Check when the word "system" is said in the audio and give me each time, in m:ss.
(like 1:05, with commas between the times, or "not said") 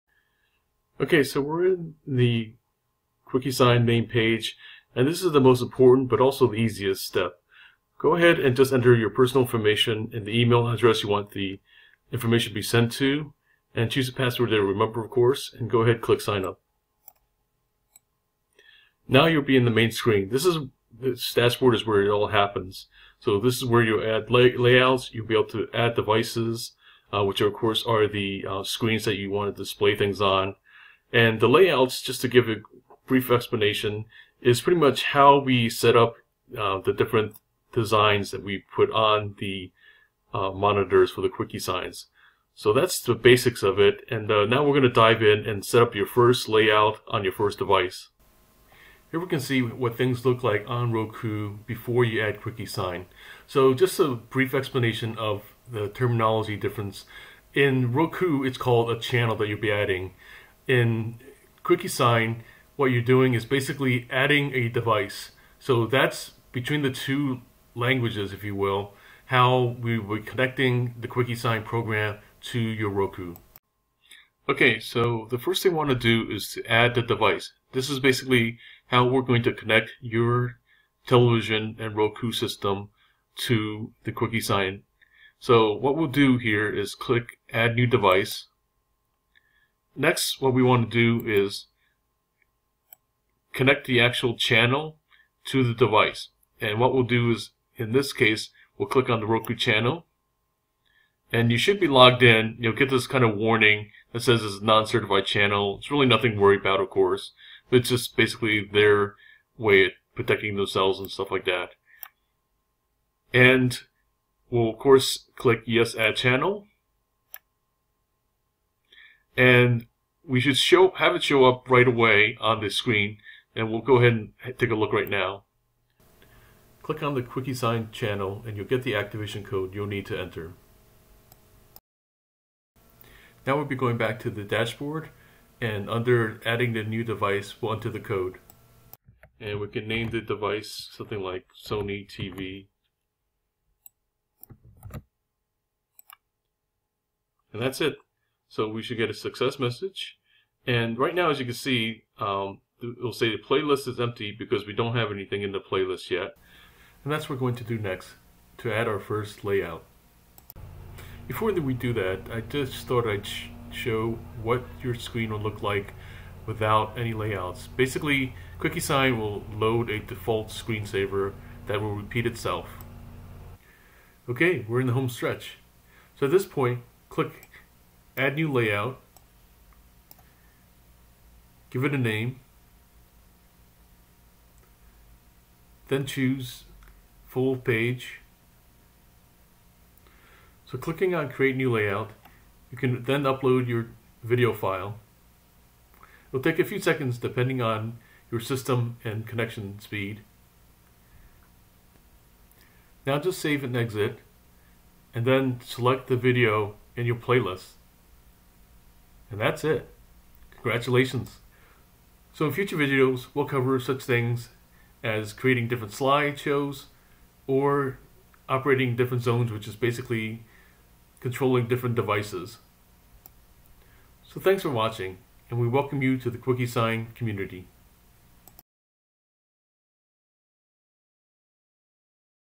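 1:22, 3:18.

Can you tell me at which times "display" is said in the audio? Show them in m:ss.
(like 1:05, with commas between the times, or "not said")
0:29.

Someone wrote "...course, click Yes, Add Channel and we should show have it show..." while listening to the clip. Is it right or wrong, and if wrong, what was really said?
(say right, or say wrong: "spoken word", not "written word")
right.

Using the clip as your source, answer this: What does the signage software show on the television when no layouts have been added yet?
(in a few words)
A default screensaver.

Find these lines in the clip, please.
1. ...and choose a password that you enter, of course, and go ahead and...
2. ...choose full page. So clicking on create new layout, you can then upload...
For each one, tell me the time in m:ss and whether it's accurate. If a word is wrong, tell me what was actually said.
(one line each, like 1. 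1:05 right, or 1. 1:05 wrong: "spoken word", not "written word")
1. 0:13 wrong: "remember", not "enter"
2. 3:06 right.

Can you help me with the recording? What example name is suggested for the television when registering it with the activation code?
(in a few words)
Sony TV.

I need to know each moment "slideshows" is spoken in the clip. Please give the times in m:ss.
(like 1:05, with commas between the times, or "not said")
3:35.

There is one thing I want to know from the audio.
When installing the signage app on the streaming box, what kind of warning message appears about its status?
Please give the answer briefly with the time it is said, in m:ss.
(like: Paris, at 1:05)
Non-certified channel, at 1:44.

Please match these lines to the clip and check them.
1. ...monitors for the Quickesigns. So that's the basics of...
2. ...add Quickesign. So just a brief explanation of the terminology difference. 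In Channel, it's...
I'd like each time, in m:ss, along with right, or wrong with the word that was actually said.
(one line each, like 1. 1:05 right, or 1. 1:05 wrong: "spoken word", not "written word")
1. 0:40 right
2. 0:52 wrong: "Roku", not "Channel".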